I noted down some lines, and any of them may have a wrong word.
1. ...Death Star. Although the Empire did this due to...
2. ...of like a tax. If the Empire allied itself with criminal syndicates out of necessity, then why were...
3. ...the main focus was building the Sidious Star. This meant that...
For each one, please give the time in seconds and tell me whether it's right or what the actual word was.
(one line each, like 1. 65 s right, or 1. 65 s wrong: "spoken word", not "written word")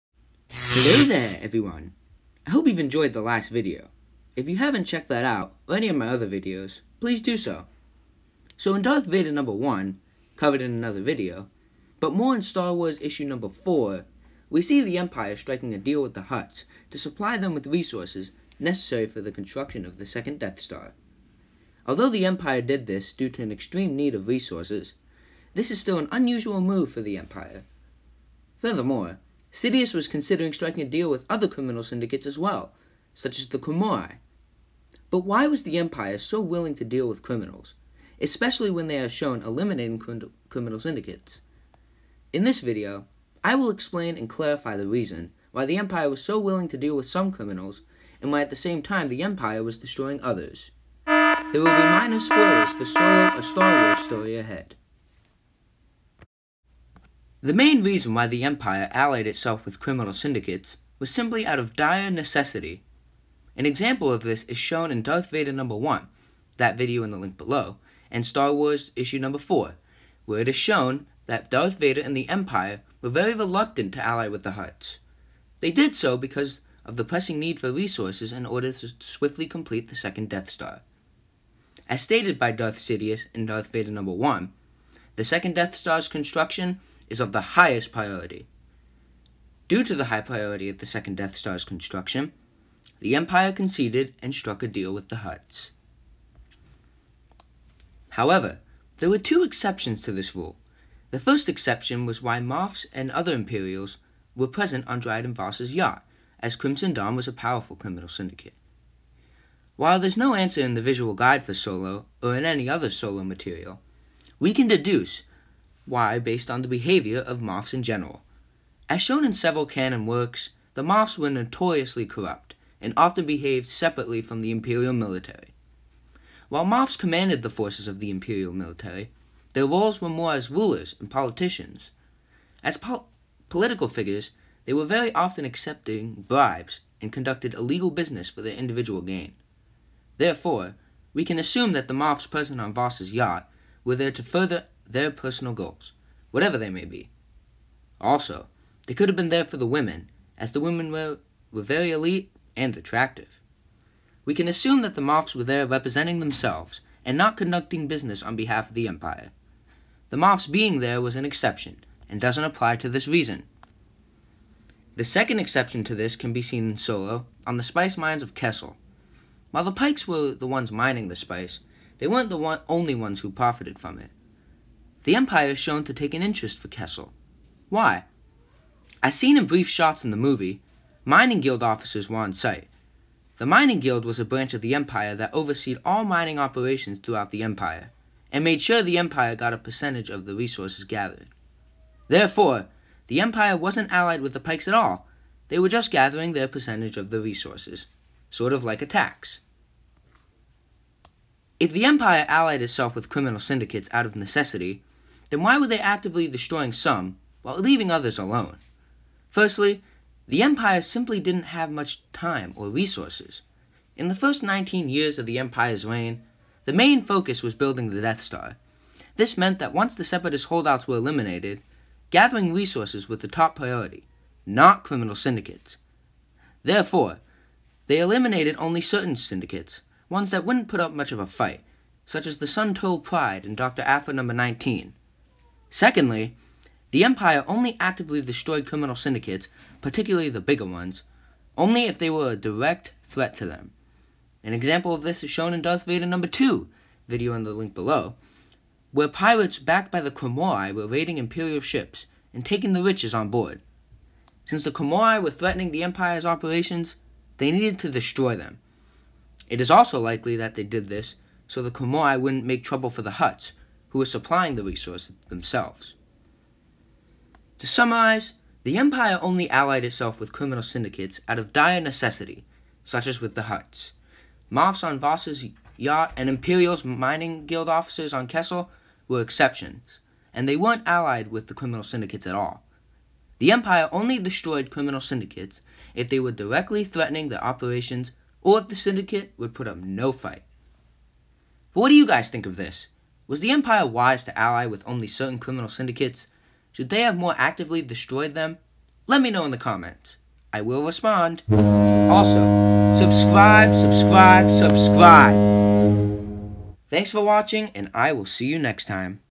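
1. 20 s right
2. 198 s right
3. 216 s wrong: "Death", not "Sidious".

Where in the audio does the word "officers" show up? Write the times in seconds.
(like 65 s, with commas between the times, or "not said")
181 s, 277 s.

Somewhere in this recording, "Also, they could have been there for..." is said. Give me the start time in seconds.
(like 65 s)
147 s.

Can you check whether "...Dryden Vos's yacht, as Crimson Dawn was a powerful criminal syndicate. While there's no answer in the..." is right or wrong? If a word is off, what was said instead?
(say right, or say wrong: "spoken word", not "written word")
right.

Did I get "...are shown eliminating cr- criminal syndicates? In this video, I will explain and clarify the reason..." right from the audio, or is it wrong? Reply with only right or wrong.
right.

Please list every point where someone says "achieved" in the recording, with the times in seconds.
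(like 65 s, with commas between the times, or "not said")
not said.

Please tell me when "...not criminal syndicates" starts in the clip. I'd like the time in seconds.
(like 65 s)
224 s.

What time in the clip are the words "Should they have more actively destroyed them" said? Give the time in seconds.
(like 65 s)
296 s.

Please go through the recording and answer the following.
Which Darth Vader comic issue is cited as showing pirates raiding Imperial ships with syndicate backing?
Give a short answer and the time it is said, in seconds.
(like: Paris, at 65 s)
Darth Vader number 2, at 245 s.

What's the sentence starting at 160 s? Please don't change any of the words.
The Moffs being there was an exception and doesn't apply to this reason.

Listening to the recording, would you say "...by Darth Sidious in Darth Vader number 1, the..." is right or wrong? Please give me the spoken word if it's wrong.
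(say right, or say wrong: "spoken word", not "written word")
right.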